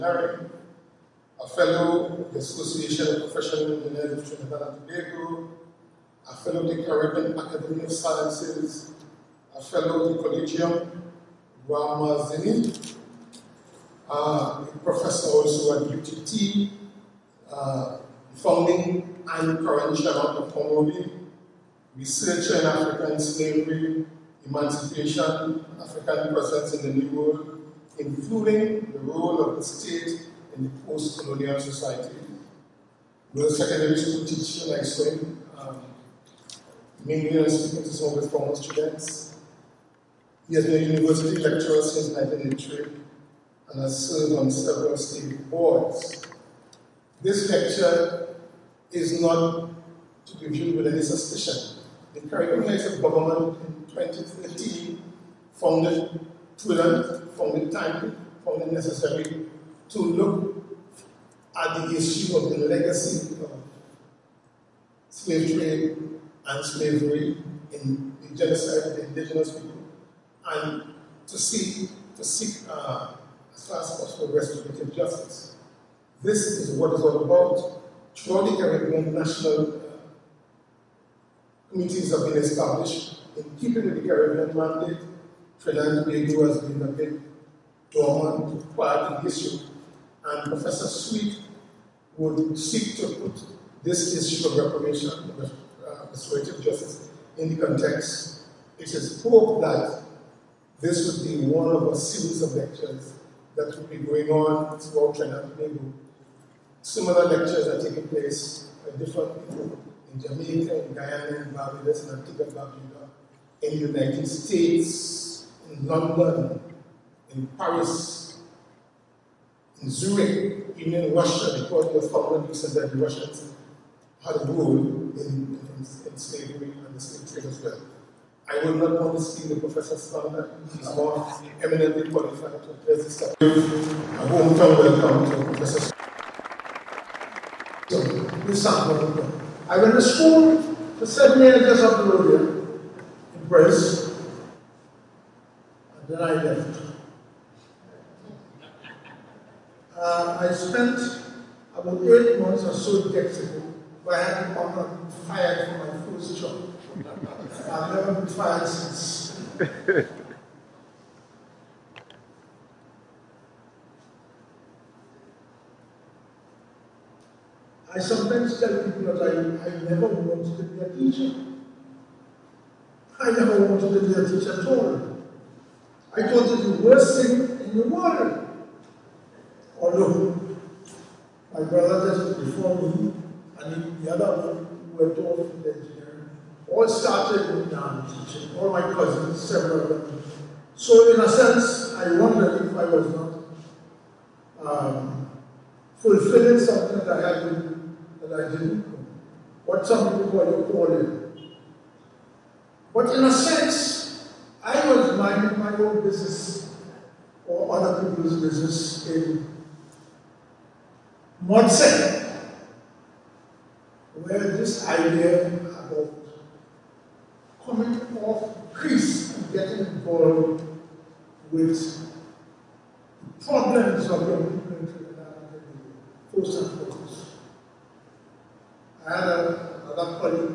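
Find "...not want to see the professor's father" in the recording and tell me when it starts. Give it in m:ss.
2:08.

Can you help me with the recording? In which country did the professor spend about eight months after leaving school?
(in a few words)
Mexico.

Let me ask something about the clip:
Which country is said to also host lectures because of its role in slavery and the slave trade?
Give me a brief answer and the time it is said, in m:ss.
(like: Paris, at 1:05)
Russia, at 2:01.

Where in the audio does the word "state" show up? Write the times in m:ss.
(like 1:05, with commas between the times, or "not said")
0:29, 0:44, 1:54.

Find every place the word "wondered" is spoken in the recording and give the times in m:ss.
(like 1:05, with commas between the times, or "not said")
3:12.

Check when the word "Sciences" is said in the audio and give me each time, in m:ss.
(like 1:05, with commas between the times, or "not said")
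0:07.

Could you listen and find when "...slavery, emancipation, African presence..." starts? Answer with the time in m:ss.
0:23.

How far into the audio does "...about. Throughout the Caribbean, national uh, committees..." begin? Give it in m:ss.
1:17.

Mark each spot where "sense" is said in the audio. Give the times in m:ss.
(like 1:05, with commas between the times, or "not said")
3:11, 3:23.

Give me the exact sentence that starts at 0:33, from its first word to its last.
With secondary school teacher like Swim, Mingling of with former students.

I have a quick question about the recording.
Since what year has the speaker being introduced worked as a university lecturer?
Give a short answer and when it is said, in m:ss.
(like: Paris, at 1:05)
1983, at 0:42.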